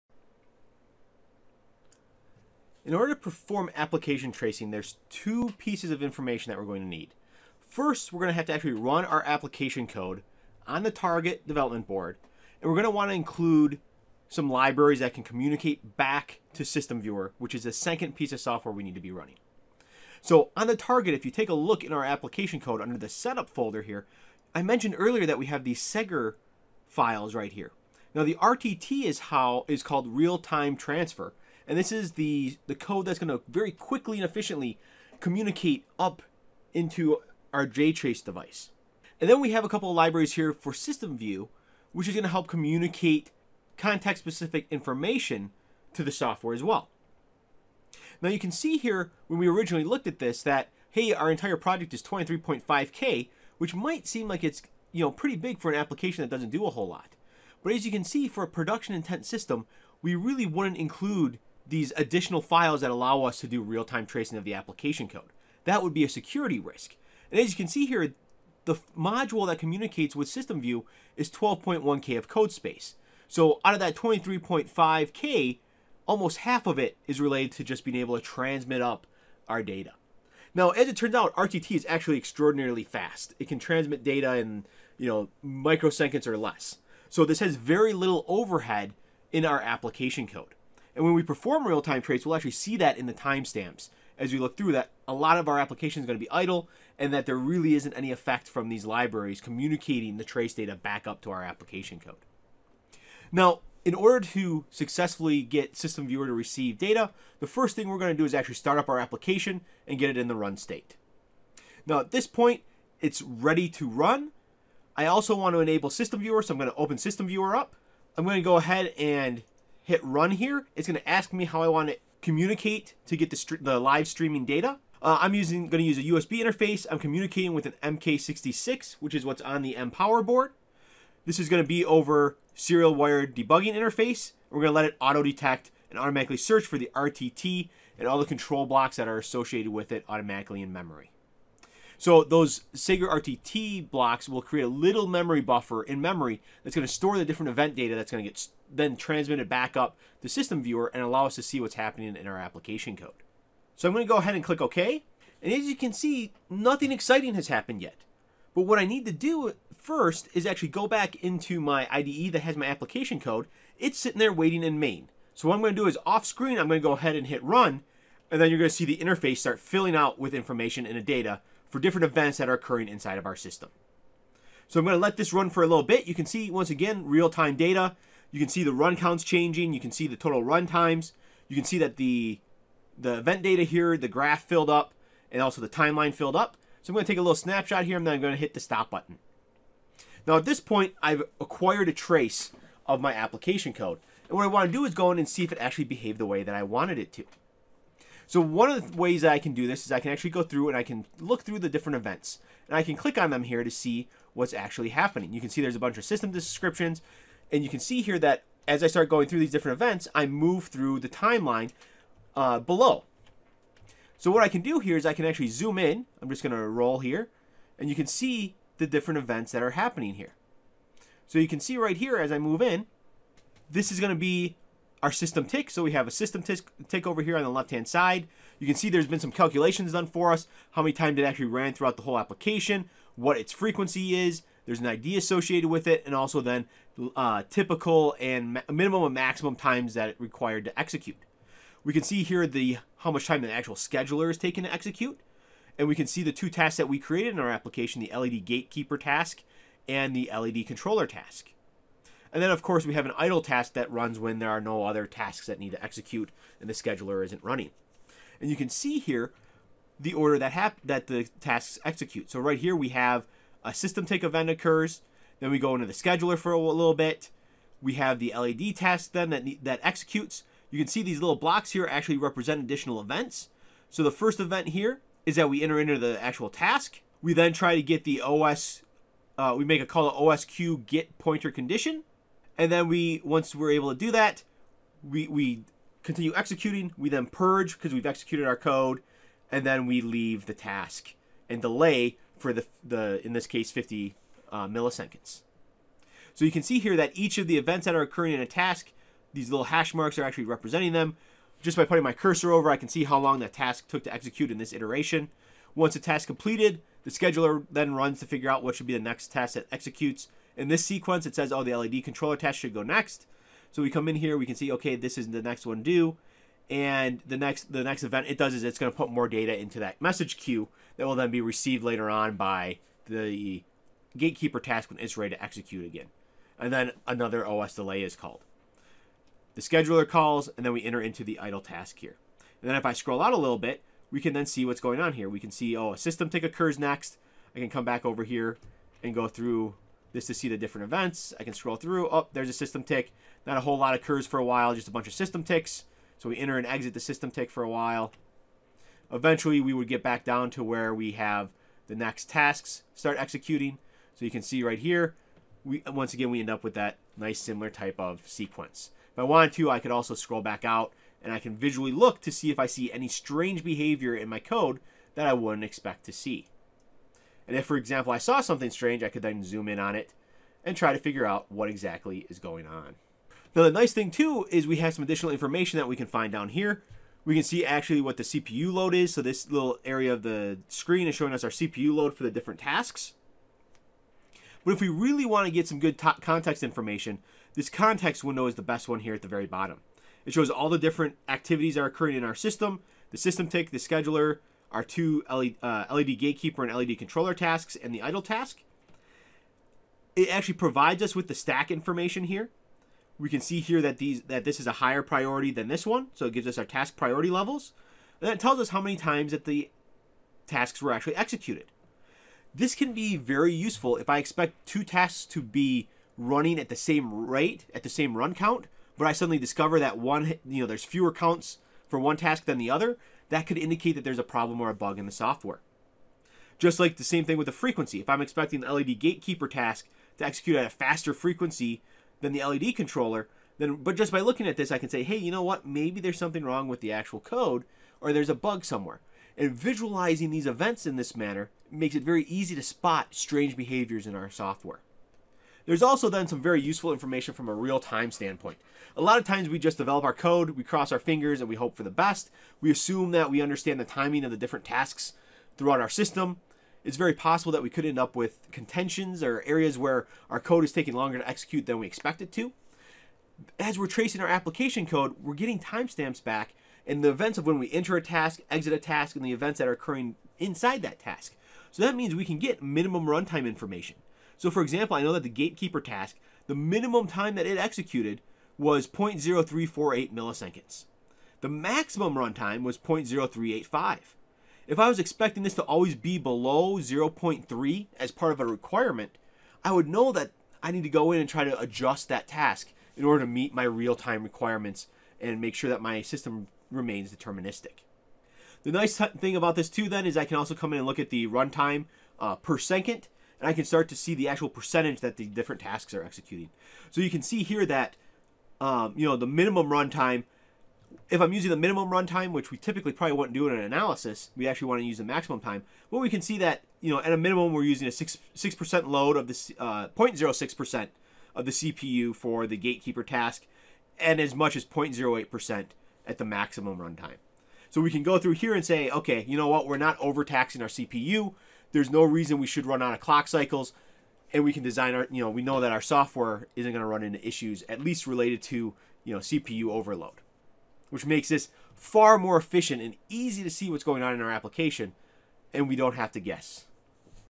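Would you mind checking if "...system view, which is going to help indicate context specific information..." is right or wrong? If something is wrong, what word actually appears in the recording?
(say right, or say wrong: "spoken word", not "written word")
wrong: "communicate", not "indicate".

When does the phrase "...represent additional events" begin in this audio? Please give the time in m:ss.
4:32.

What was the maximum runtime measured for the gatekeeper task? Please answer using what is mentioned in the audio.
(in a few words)
0.0385.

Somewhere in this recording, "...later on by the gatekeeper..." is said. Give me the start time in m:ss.
5:21.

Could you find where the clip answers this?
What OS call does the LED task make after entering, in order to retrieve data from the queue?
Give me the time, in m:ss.
4:40.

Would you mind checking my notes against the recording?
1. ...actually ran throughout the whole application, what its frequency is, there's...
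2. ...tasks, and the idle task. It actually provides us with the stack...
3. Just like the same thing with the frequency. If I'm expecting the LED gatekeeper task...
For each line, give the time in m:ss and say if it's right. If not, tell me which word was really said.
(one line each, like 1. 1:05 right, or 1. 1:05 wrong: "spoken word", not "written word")
1. 3:51 right
2. 6:37 right
3. 7:06 right.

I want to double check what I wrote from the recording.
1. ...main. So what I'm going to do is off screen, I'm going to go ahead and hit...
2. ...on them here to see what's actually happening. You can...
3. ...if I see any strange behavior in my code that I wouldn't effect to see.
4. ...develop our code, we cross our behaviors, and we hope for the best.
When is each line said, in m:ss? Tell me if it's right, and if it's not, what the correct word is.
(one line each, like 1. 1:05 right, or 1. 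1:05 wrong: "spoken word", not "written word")
1. 2:44 right
2. 3:23 right
3. 6:02 wrong: "expect", not "effect"
4. 7:29 wrong: "fingers", not "behaviors".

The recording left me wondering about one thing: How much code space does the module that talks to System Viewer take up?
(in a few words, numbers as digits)
12.1K.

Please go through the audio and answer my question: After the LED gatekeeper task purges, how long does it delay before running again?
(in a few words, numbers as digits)
50 milliseconds.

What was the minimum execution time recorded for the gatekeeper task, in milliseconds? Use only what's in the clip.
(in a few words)
0.0348 milliseconds.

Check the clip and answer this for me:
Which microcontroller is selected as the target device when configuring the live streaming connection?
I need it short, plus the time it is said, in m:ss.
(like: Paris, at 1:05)
MK66, at 2:07.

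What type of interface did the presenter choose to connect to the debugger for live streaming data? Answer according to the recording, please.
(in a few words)
USB.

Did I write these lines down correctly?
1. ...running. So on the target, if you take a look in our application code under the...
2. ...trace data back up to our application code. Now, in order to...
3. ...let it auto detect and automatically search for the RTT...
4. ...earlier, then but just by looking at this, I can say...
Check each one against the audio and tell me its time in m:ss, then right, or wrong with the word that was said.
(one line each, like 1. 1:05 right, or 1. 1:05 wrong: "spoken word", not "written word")
1. 0:19 right
2. 1:40 right
3. 2:14 right
4. 7:12 wrong: "controller", not "earlier".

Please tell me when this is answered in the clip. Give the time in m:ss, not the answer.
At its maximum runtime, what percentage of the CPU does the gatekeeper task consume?
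8:44.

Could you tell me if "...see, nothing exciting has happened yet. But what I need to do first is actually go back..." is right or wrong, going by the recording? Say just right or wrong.
right.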